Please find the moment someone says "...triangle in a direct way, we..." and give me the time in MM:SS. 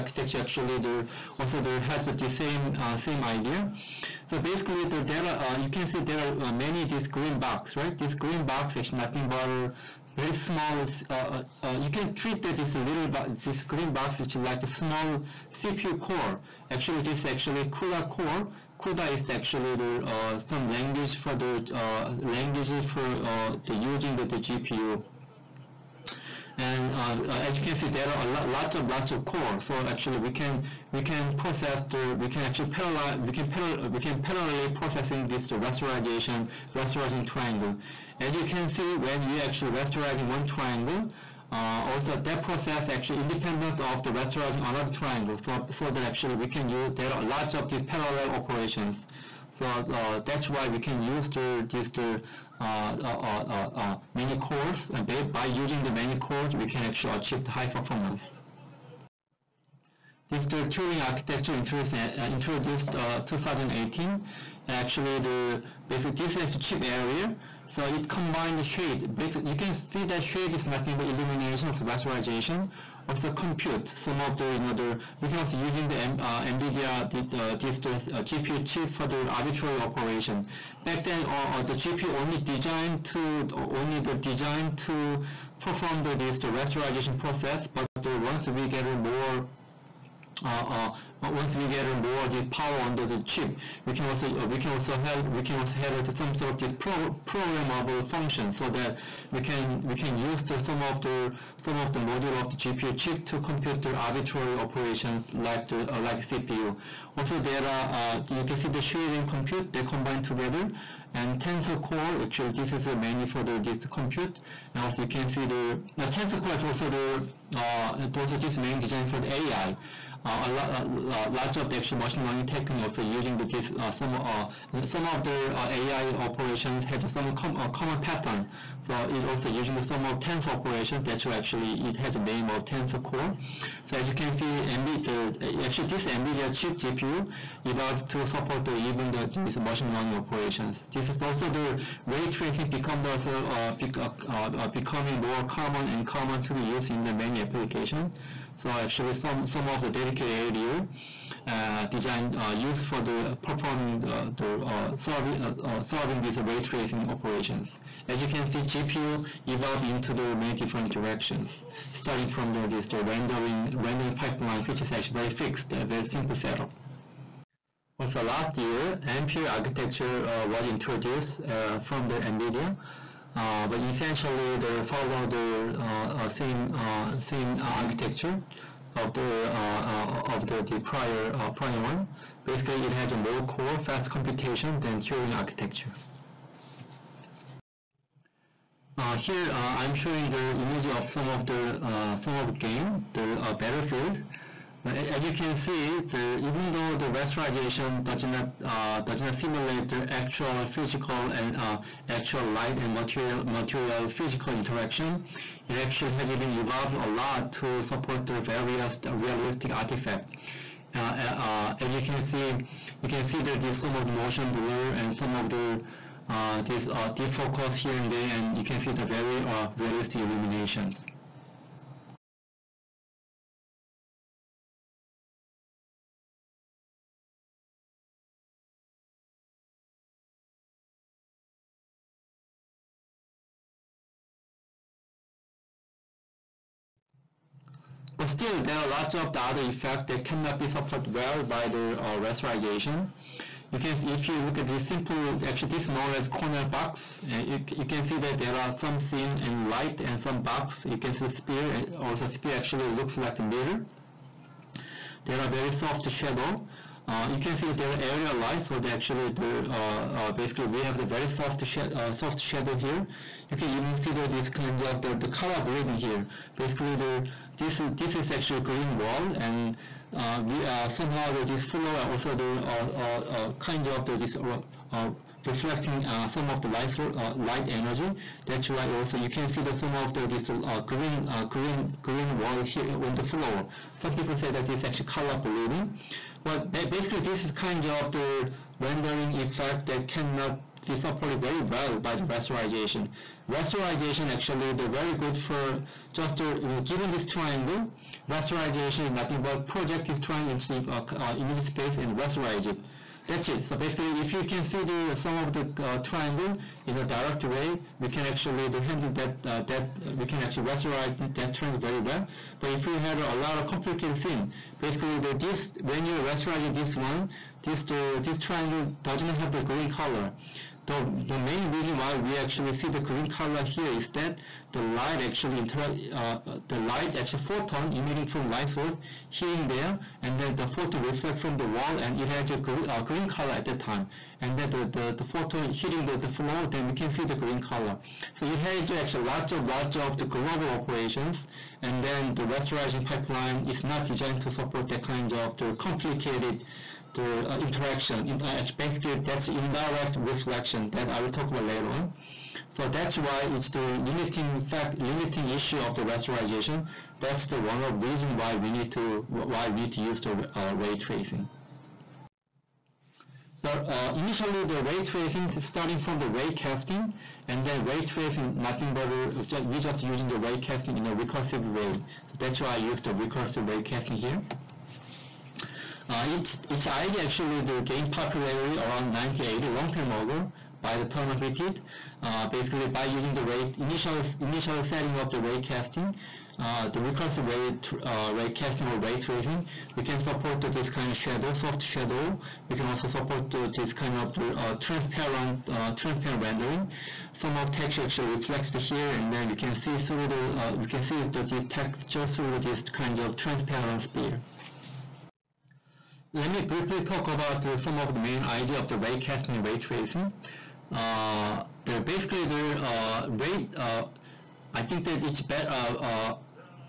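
05:05.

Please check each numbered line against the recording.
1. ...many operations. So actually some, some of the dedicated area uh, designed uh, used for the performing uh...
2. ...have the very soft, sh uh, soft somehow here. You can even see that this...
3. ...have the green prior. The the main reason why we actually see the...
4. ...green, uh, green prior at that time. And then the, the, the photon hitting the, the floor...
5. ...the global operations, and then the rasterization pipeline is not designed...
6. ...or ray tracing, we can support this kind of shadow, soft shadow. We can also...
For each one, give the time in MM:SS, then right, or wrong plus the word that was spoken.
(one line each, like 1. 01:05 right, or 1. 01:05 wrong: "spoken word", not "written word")
1. 02:27 wrong: "applications", not "operations"
2. 04:20 wrong: "shadow", not "somehow"
3. 05:19 wrong: "color", not "prior"
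4. 05:32 wrong: "color", not "prior"
5. 05:40 right
6. 06:28 right.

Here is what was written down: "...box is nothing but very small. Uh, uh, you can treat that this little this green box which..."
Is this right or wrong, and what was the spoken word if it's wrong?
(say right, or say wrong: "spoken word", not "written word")
right.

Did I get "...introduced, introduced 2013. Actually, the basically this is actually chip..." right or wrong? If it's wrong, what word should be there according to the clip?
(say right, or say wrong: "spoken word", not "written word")
wrong: "2018", not "2013".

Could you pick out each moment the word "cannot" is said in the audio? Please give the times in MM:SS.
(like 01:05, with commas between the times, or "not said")
04:00, 04:50.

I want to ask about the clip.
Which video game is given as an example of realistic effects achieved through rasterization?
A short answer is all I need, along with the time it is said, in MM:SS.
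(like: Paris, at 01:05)
Battlefield, at 03:13.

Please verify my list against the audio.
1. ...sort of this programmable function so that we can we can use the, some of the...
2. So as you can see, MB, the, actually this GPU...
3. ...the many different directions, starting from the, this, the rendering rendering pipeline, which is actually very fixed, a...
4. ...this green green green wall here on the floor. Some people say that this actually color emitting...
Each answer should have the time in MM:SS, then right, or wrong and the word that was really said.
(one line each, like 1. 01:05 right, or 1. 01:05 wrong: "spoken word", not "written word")
1. 01:36 right
2. 02:13 wrong: "NVIDIA", not "GPU"
3. 02:40 right
4. 04:40 wrong: "bleeding", not "emitting".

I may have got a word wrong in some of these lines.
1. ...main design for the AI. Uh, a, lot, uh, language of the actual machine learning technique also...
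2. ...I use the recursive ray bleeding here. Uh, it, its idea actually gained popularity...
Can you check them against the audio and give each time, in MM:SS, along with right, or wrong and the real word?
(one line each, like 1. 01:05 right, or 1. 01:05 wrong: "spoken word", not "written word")
1. 01:58 wrong: "large", not "language"
2. 06:12 wrong: "casting", not "bleeding".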